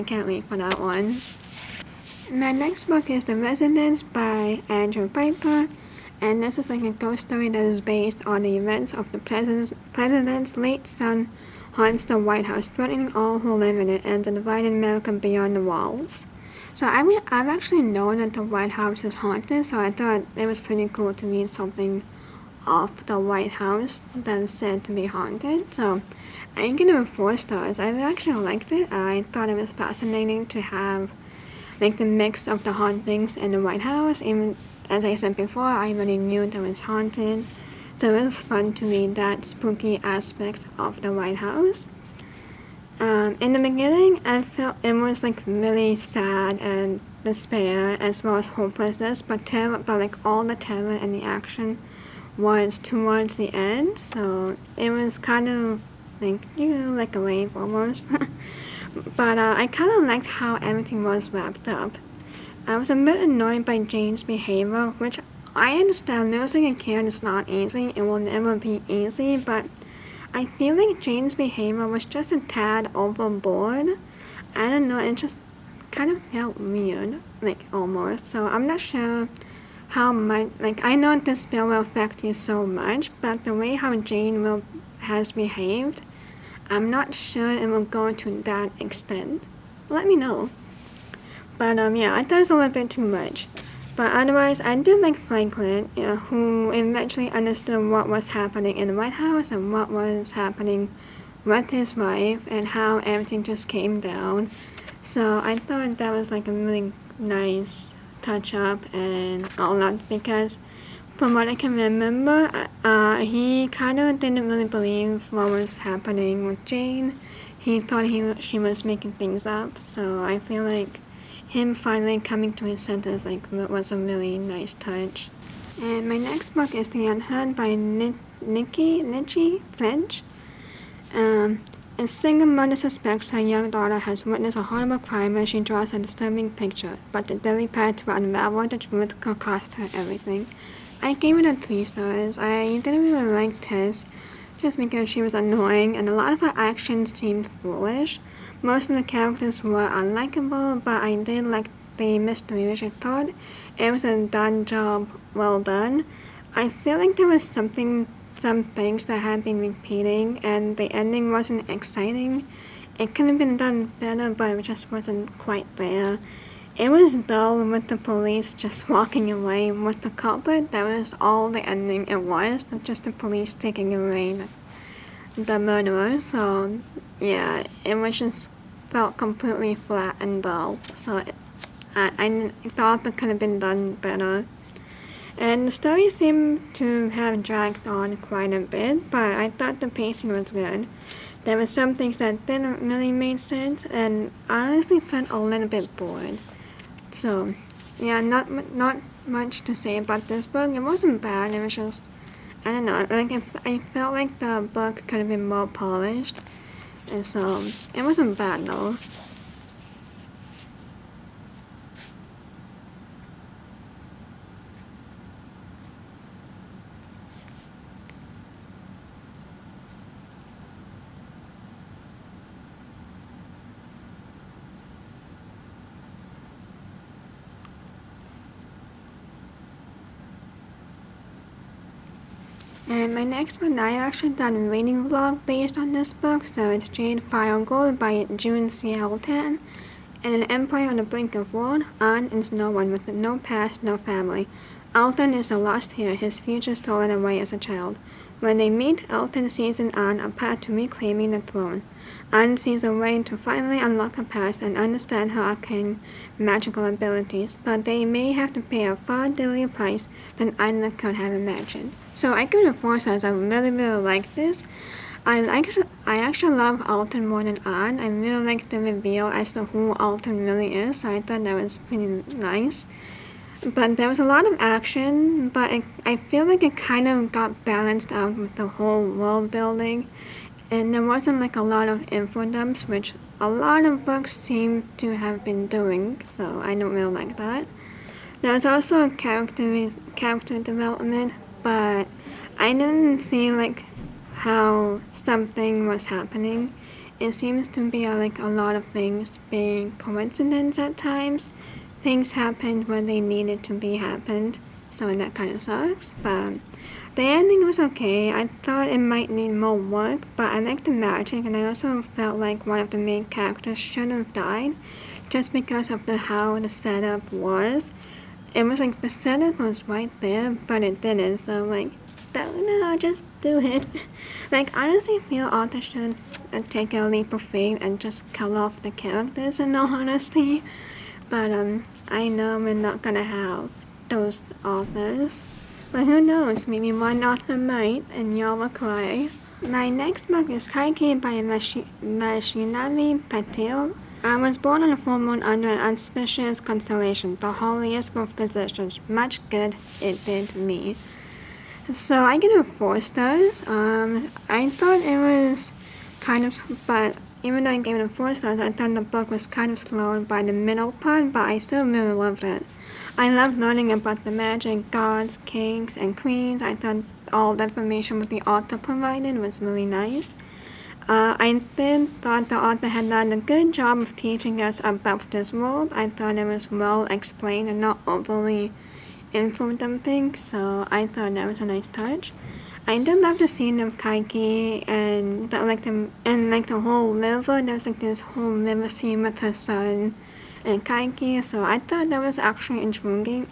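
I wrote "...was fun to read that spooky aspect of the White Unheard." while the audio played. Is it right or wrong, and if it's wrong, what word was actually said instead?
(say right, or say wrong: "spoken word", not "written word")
wrong: "House", not "Unheard".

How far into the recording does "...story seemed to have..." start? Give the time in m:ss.
3:05.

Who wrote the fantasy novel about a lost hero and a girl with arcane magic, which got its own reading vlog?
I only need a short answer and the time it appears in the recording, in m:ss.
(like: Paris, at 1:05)
June C. Tan, at 3:58.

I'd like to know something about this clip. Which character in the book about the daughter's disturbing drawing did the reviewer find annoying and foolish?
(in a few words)
Tess.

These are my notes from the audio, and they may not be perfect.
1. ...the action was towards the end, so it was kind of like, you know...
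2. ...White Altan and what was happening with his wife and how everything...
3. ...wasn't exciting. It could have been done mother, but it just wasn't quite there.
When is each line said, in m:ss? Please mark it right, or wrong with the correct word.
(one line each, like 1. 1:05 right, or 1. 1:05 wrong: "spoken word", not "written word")
1. 0:51 right
2. 1:38 wrong: "House", not "Altan"
3. 2:41 wrong: "better", not "mother".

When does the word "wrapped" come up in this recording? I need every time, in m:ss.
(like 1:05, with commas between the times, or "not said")
1:01.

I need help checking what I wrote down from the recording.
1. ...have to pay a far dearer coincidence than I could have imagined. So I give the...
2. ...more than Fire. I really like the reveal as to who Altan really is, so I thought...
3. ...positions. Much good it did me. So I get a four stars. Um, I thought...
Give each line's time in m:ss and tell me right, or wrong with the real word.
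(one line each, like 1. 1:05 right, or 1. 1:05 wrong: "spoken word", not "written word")
1. 4:18 wrong: "price", not "coincidence"
2. 4:27 wrong: "Anne", not "Fire"
3. 5:48 right.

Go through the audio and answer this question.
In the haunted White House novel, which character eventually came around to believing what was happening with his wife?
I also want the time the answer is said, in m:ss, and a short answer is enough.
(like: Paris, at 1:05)
Franklin, at 1:35.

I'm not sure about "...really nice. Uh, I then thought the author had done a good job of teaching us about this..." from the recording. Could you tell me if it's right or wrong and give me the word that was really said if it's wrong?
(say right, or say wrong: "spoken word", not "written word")
right.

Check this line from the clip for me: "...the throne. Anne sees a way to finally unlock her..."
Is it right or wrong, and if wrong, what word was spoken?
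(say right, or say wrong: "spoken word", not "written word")
right.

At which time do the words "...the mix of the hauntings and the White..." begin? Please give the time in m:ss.
0:31.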